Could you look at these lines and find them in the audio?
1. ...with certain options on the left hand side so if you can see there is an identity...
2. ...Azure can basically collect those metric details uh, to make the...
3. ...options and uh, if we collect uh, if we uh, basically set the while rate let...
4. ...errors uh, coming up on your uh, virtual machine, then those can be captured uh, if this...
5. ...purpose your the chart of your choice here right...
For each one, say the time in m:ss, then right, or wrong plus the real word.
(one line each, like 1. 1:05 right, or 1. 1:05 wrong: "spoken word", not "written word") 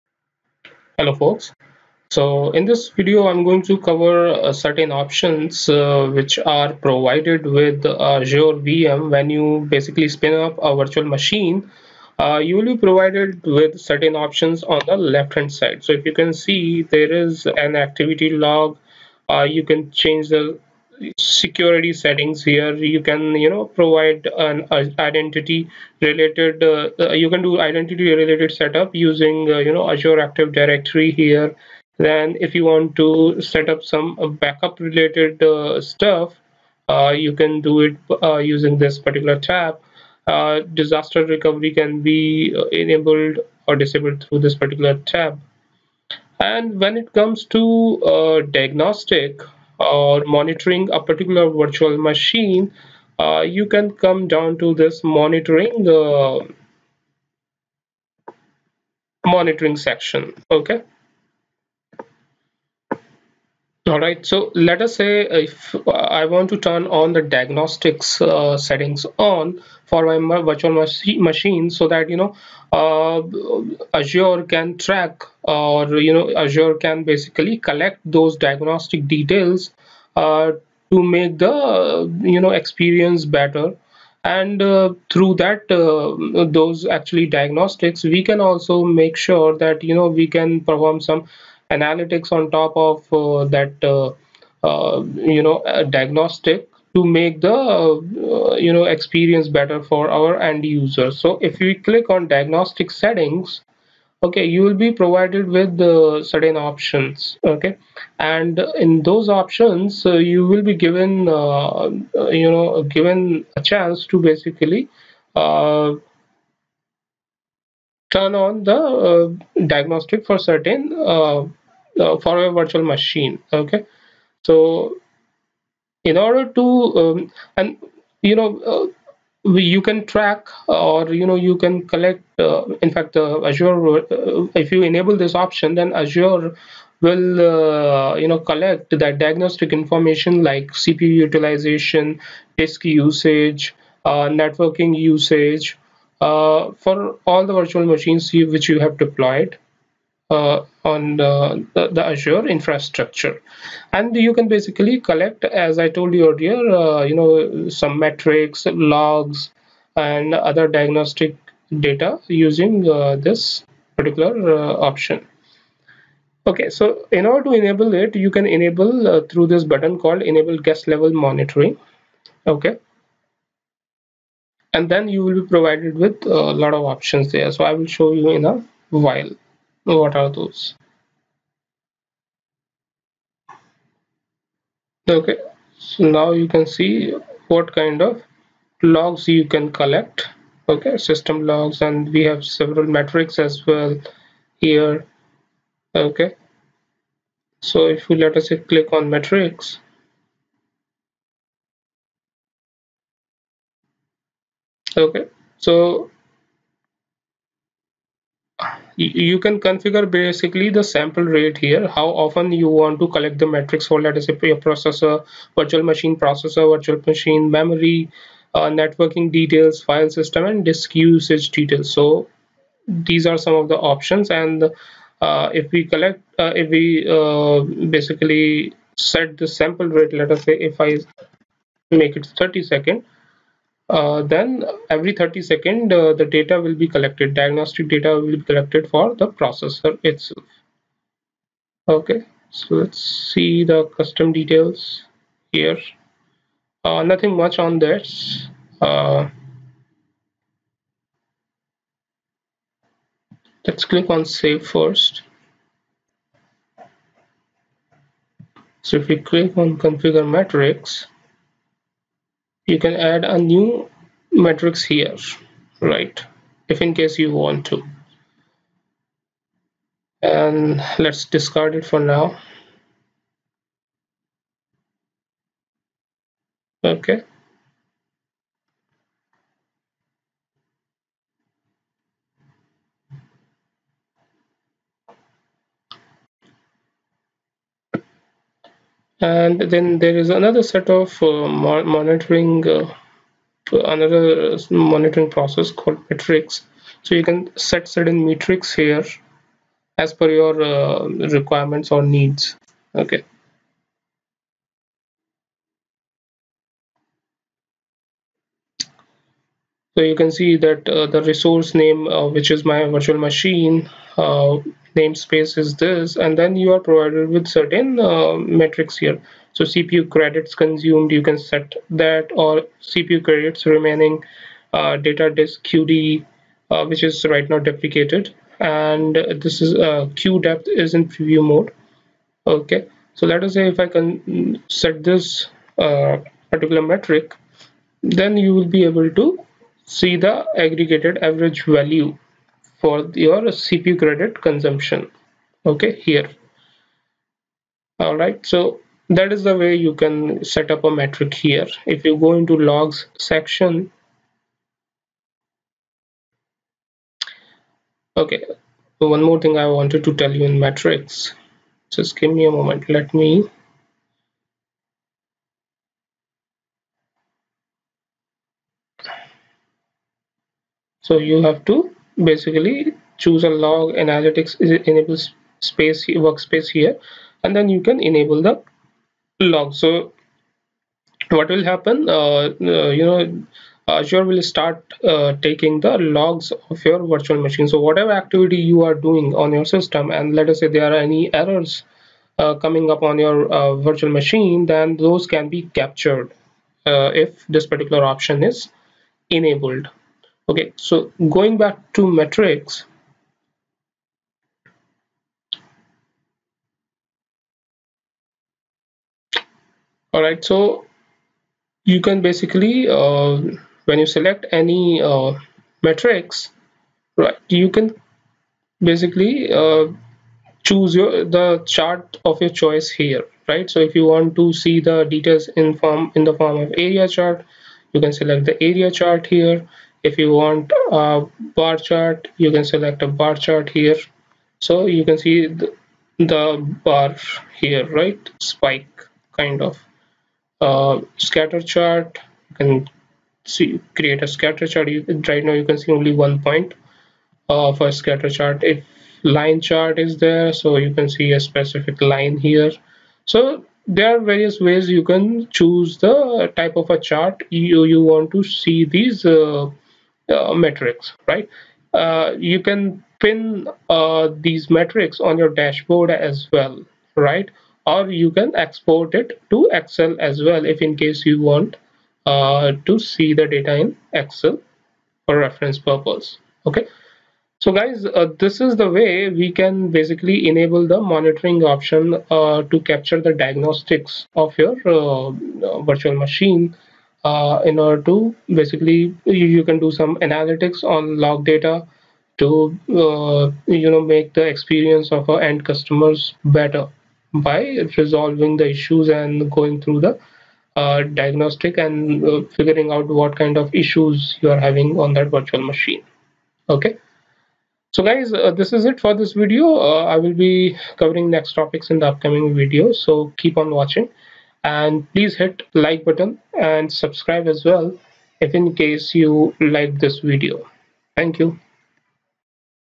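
1. 0:13 wrong: "activity", not "identity"
2. 1:16 wrong: "diagnostic", not "metric"
3. 3:43 wrong: "sample", not "while"
4. 6:31 right
5. 7:00 wrong: "choose", not "purpose".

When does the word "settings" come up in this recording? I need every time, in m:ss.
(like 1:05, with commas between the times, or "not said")
0:21, 1:08, 1:42.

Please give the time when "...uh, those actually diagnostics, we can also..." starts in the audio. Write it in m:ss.
1:25.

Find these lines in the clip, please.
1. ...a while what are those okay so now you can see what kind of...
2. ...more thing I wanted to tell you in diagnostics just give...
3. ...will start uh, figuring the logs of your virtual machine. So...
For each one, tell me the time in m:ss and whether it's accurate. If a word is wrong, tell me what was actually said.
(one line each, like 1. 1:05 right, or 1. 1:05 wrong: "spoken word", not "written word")
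1. 2:58 right
2. 5:59 wrong: "metrics", not "diagnostics"
3. 6:24 wrong: "taking", not "figuring".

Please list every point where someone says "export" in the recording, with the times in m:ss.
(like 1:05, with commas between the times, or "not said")
7:48.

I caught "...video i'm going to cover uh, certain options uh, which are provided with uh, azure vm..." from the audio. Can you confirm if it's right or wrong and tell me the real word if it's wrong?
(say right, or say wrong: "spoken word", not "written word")
right.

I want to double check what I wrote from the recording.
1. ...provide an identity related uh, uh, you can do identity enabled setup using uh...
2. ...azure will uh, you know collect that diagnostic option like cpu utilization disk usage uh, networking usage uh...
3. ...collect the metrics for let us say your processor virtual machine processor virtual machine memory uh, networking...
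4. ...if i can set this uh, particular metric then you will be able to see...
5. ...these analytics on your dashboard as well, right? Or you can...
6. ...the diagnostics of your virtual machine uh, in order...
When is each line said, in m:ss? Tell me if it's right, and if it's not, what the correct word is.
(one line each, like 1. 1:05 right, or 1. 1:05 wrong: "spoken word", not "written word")
1. 0:23 wrong: "related", not "enabled"
2. 2:16 wrong: "information", not "option"
3. 3:33 right
4. 5:33 right
5. 7:44 wrong: "metrics", not "analytics"
6. 8:03 right.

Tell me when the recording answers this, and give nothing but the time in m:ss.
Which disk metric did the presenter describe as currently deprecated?
5:24.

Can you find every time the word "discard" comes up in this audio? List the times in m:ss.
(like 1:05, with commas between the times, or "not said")
4:31.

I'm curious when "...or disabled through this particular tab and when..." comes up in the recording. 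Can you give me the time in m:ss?
0:43.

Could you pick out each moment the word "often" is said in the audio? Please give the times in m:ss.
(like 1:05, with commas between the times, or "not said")
3:32.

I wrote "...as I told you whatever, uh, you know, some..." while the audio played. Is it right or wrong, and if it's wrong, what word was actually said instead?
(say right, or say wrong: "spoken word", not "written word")
wrong: "earlier", not "whatever".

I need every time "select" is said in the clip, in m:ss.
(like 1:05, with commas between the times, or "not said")
6:54, 7:08, 7:12.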